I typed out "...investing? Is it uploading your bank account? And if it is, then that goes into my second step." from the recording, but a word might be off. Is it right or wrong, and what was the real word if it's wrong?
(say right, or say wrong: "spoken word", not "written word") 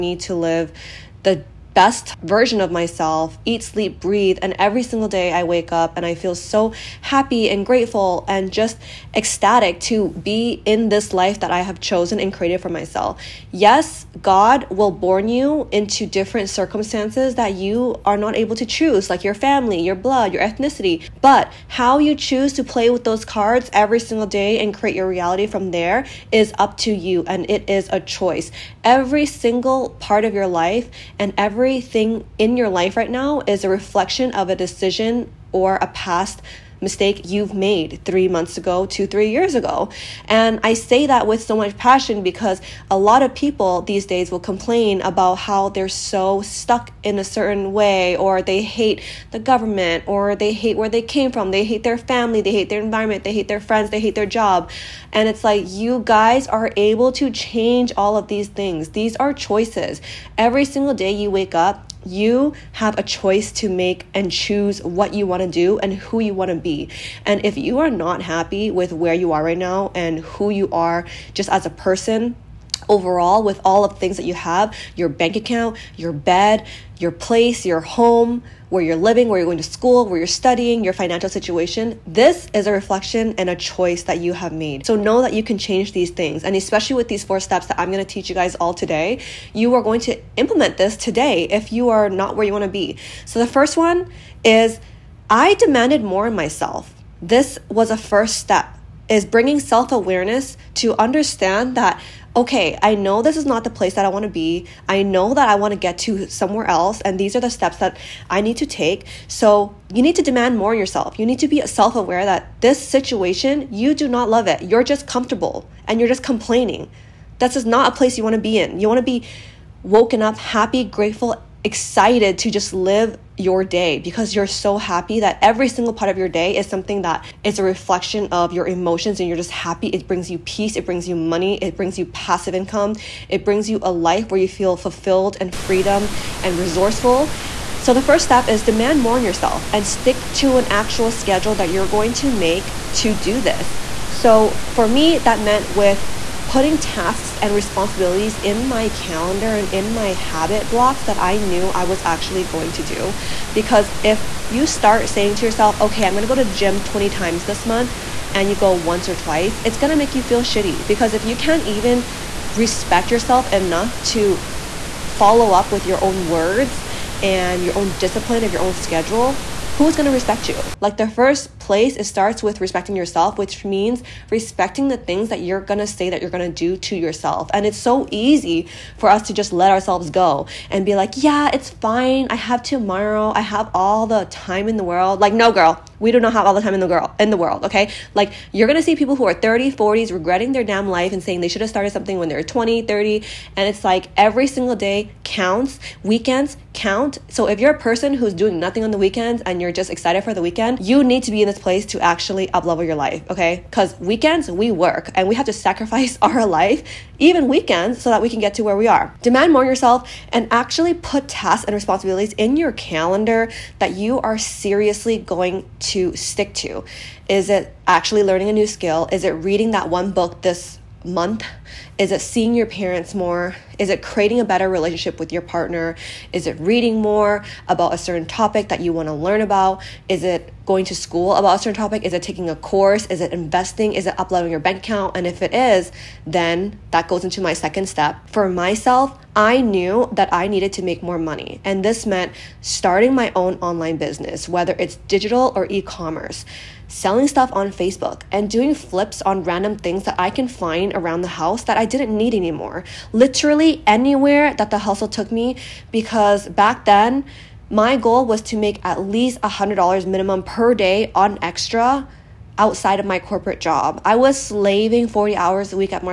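right.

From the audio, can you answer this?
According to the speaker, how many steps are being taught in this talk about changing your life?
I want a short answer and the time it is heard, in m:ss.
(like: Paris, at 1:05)
4, at 1:27.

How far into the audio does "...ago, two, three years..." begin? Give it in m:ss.
0:38.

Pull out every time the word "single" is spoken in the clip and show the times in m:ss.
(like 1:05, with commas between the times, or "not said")
0:04, 0:23, 0:29, 1:00, 2:05, 3:14.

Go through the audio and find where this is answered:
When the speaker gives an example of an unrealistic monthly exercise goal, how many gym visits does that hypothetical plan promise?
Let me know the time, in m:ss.
2:36.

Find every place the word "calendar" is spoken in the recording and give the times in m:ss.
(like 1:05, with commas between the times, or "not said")
2:28, 3:32.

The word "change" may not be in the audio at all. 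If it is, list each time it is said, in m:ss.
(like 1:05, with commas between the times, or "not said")
0:57, 1:25.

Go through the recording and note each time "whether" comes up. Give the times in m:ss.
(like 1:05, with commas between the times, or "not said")
4:04.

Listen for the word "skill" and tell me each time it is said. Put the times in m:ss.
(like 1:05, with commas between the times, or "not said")
3:38.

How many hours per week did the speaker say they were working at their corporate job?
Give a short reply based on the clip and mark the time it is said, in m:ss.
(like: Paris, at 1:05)
40 hours, at 4:25.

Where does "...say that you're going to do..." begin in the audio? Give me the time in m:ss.
2:55.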